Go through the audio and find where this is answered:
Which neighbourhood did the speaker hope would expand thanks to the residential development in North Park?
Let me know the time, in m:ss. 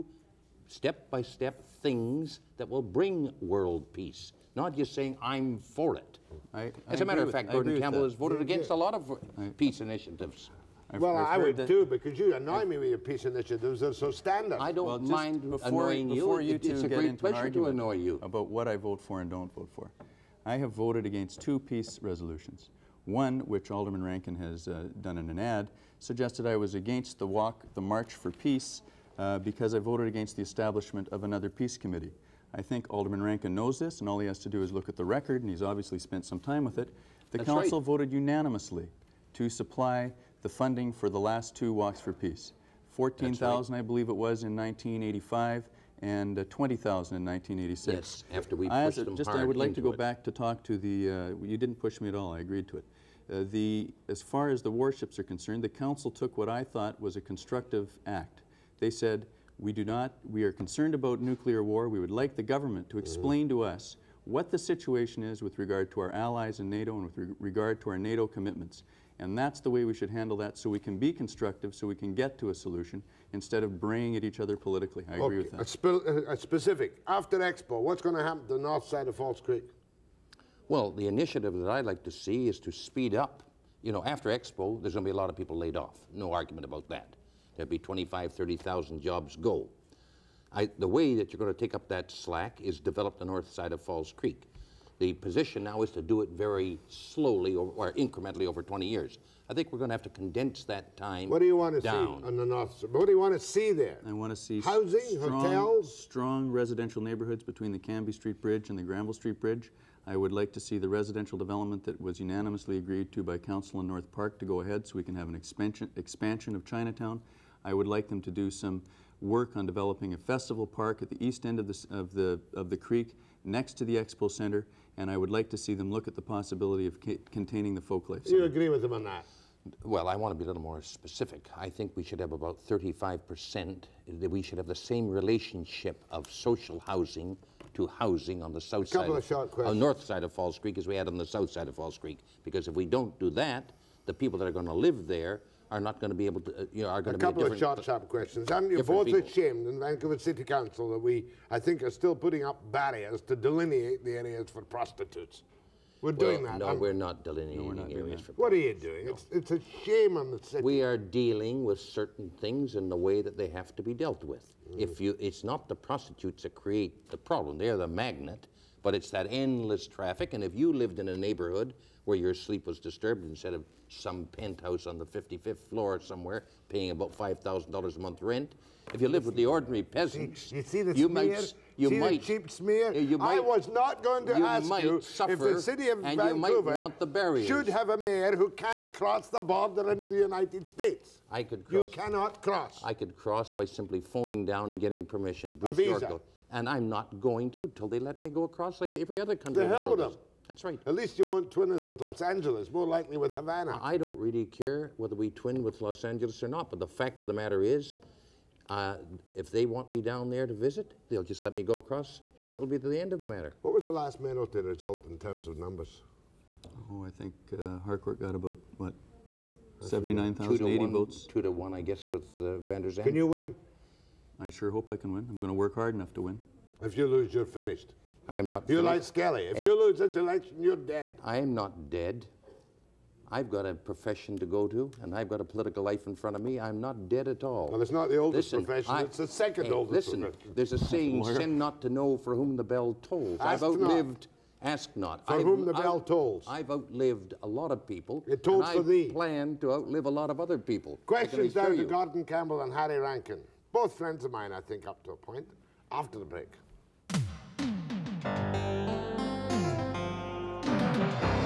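1:56.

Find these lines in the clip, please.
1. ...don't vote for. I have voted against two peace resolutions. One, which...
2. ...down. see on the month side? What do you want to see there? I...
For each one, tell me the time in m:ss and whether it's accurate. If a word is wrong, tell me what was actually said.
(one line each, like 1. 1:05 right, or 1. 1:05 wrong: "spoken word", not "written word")
1. 0:19 right
2. 1:41 wrong: "north", not "month".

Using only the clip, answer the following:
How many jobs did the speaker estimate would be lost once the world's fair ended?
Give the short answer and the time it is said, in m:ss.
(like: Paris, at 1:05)
25,000 to 30,000, at 1:27.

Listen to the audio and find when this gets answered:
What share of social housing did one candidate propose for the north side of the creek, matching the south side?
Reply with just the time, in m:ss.
2:12.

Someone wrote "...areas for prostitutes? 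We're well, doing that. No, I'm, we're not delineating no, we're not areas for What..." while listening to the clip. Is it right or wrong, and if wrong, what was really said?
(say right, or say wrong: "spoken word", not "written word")
right.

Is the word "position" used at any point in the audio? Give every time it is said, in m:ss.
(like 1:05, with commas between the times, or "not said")
1:35.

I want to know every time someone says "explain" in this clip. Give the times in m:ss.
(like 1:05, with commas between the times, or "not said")
1:02.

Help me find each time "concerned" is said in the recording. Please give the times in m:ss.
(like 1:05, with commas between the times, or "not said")
0:55, 1:00.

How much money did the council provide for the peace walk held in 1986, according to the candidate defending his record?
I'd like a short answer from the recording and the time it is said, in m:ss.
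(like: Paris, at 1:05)
$20,000, at 0:46.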